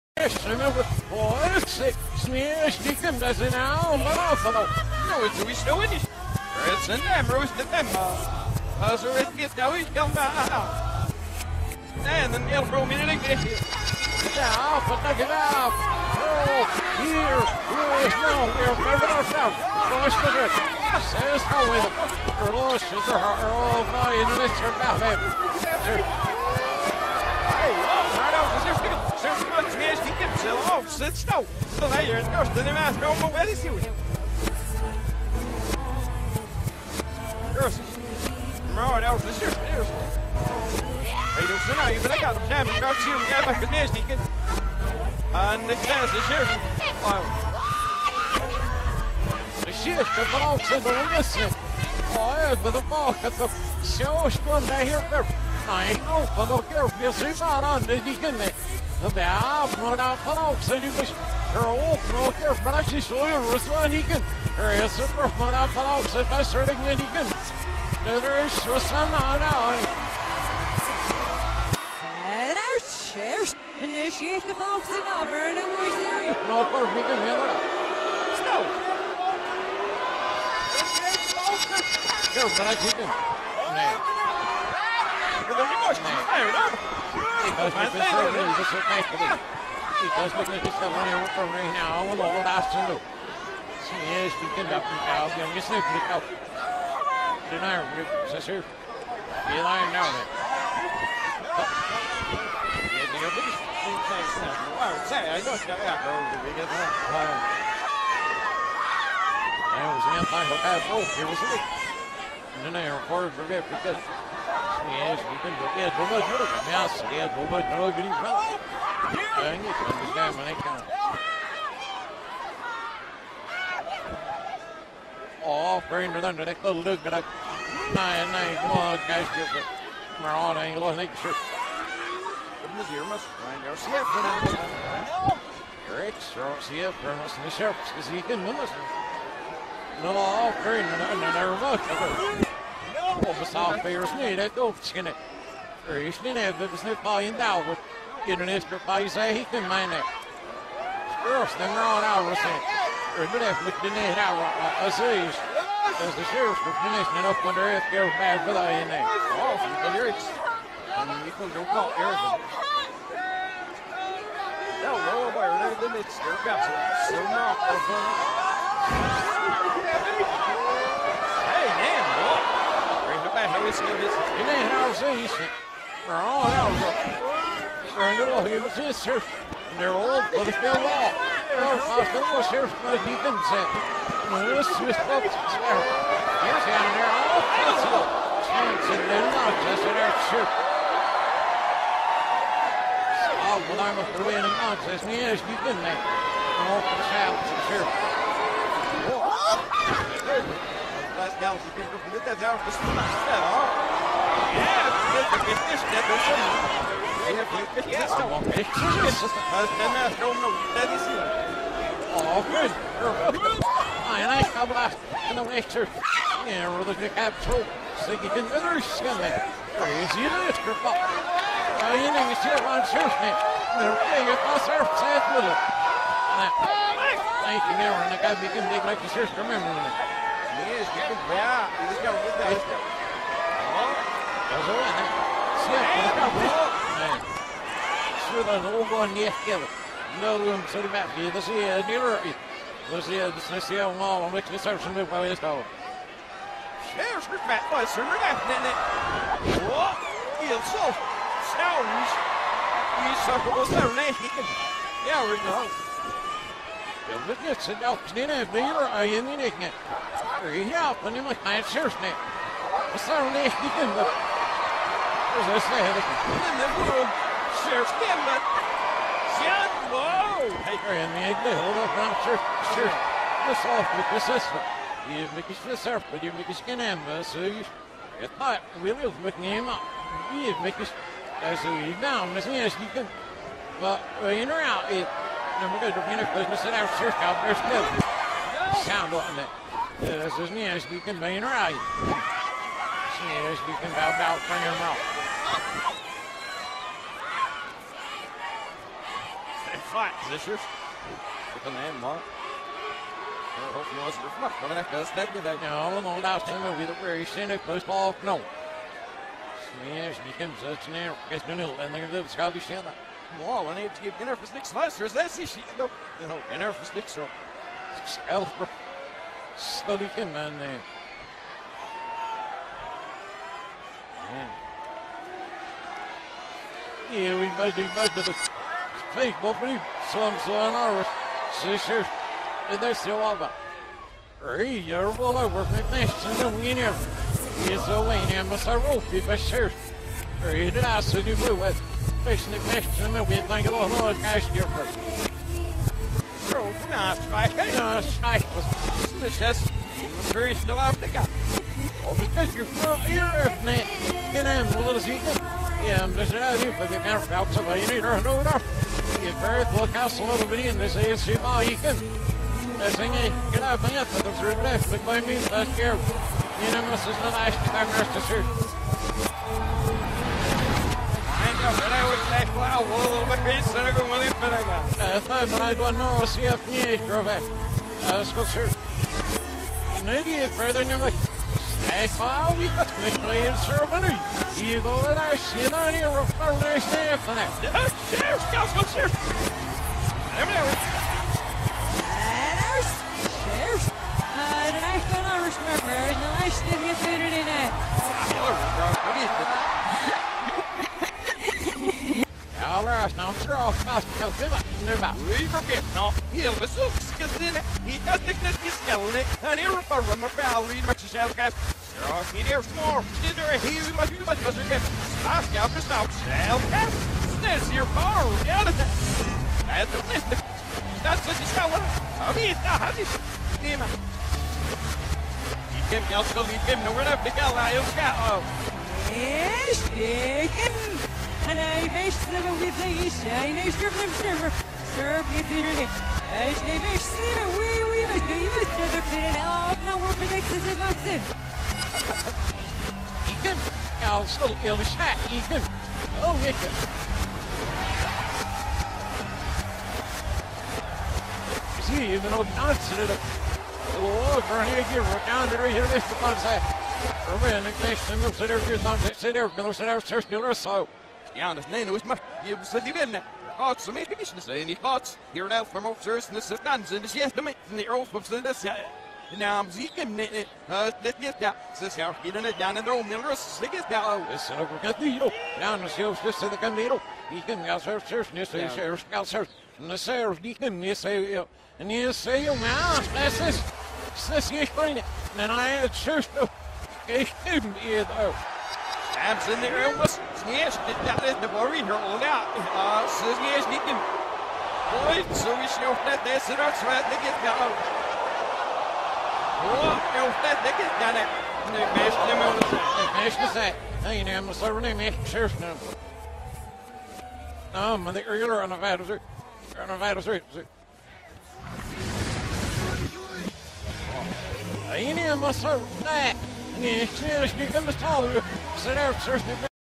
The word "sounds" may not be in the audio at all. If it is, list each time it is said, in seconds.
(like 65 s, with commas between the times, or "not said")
251 s, 288 s.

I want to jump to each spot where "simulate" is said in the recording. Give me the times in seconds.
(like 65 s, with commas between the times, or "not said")
not said.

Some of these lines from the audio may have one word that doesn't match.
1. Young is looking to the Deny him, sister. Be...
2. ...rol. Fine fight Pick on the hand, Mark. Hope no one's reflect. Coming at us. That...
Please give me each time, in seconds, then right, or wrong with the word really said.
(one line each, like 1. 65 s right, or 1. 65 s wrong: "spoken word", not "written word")
1. 95 s right
2. 294 s right.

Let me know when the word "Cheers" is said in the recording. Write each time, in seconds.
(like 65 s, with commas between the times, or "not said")
73 s.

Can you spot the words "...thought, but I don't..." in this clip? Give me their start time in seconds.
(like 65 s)
375 s.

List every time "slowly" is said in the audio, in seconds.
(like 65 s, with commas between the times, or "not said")
319 s.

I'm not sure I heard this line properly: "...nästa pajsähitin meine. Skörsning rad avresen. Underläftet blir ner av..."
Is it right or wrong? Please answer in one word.
right.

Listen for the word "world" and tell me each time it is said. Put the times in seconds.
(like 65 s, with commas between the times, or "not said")
266 s.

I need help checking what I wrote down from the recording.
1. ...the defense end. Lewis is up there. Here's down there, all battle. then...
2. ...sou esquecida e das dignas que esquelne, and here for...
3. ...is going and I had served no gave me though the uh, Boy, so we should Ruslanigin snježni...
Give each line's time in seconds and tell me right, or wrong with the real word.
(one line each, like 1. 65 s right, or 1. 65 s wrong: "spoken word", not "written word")
1. 182 s wrong: "possible", not "battle"
2. 406 s right
3. 484 s wrong: "Absolutno", not "Ruslanigin".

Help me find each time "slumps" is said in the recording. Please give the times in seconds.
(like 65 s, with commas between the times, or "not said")
330 s.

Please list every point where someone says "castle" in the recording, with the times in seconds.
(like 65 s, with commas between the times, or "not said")
359 s.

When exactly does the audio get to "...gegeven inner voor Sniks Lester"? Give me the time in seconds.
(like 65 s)
313 s.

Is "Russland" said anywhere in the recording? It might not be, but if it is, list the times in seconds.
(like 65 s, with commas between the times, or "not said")
39 s, 51 s.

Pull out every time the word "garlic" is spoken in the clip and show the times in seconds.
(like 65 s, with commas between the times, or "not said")
not said.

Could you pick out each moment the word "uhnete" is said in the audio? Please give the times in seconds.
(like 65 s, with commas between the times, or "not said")
495 s, 500 s.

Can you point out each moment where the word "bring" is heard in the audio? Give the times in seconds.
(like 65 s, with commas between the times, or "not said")
125 s, 140 s.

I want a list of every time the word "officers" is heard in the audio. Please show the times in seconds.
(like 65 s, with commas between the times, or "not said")
465 s.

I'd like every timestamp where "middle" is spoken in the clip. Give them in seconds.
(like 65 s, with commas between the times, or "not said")
271 s, 473 s.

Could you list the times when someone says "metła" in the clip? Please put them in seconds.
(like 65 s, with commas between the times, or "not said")
247 s.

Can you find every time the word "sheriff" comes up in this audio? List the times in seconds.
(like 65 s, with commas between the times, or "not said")
156 s, 267 s.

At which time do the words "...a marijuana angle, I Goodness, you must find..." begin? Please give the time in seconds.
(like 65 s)
129 s.